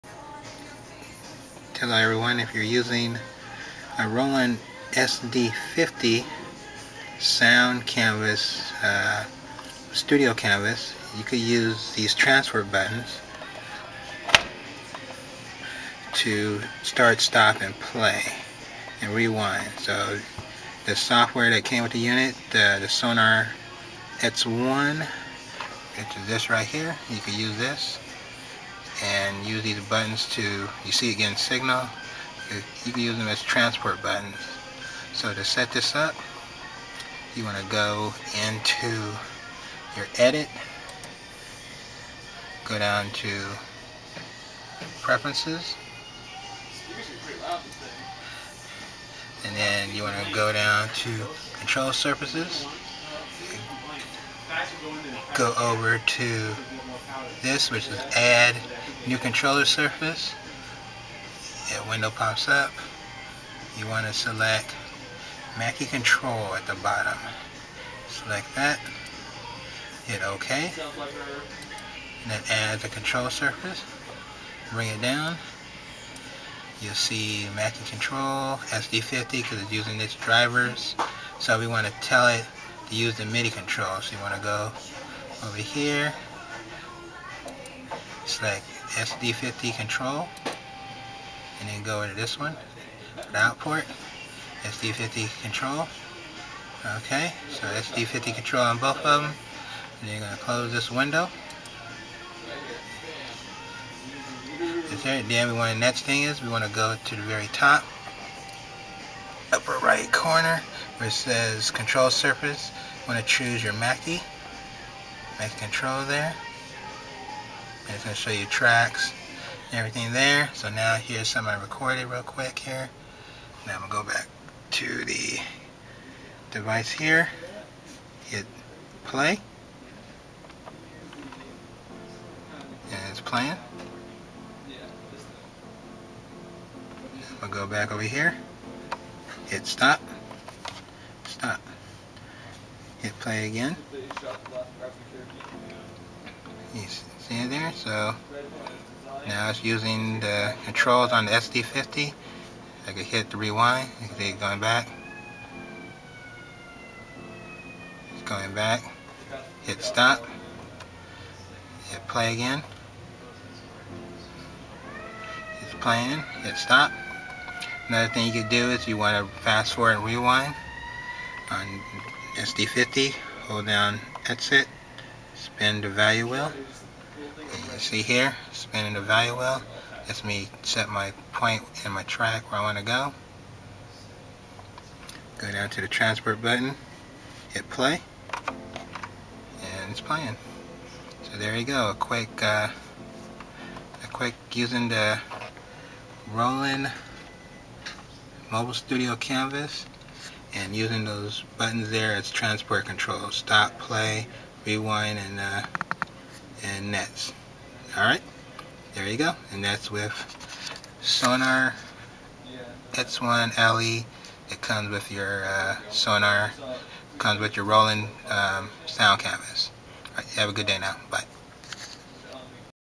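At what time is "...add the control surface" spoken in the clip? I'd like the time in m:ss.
1:12.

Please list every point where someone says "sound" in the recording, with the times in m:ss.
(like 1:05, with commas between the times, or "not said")
0:07, 3:38.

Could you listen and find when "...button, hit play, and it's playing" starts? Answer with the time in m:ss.
3:06.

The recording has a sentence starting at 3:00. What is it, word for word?
That's me set my point and my track where I want to go.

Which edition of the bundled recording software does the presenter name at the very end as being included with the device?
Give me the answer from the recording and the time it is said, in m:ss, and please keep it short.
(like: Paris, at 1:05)
Sonar X1 LE, at 3:31.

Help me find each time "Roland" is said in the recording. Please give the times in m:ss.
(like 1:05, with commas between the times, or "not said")
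0:04, 3:16, 3:37.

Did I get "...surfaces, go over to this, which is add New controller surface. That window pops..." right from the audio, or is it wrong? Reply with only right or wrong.
right.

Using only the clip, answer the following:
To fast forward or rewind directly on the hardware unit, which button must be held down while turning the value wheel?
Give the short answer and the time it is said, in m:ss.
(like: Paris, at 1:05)
exit, at 2:54.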